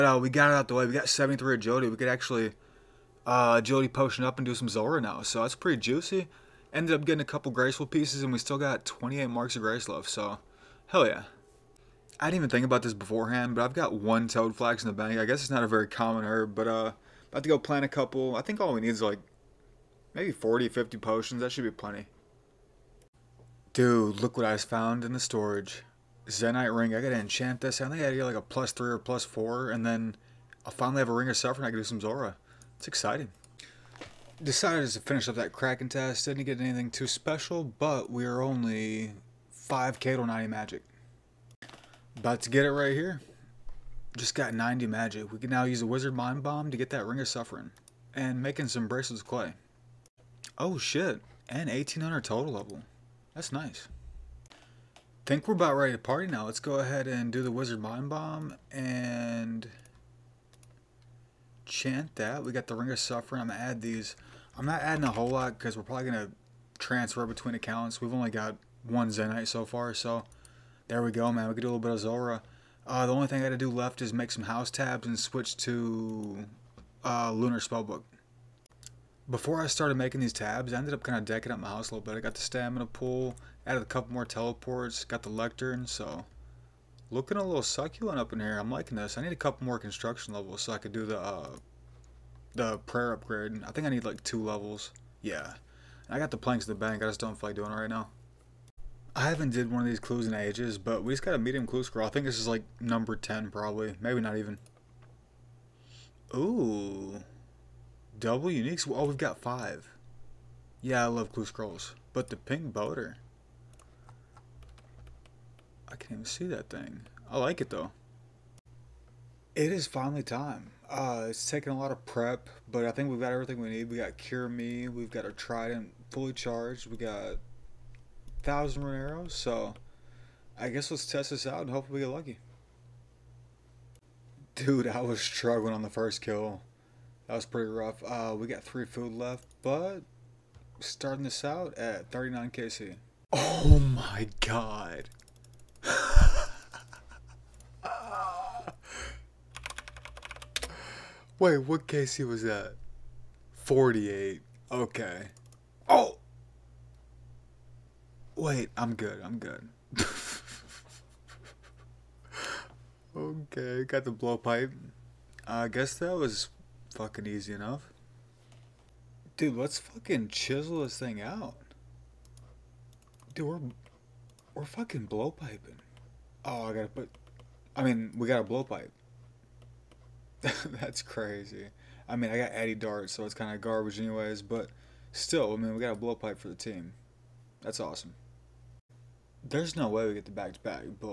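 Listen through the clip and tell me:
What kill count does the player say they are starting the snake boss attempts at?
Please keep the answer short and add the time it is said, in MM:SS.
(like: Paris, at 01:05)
39, at 02:22.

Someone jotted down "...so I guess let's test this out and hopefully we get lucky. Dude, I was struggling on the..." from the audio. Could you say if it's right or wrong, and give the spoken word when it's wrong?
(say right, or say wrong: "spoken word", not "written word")
right.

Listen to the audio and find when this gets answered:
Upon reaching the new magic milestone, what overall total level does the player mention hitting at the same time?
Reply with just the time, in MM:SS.
00:51.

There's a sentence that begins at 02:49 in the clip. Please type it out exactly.
Dude, let's fucking chisel this thing out.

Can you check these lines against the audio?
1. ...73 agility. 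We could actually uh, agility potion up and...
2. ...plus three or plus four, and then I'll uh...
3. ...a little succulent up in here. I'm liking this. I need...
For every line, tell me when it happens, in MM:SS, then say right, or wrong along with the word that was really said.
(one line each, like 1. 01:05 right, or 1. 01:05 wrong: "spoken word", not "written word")
1. 00:01 right
2. 00:28 right
3. 01:27 right.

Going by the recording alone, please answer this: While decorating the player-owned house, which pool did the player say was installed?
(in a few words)
stamina pool.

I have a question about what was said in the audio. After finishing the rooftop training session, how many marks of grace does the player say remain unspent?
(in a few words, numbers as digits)
28.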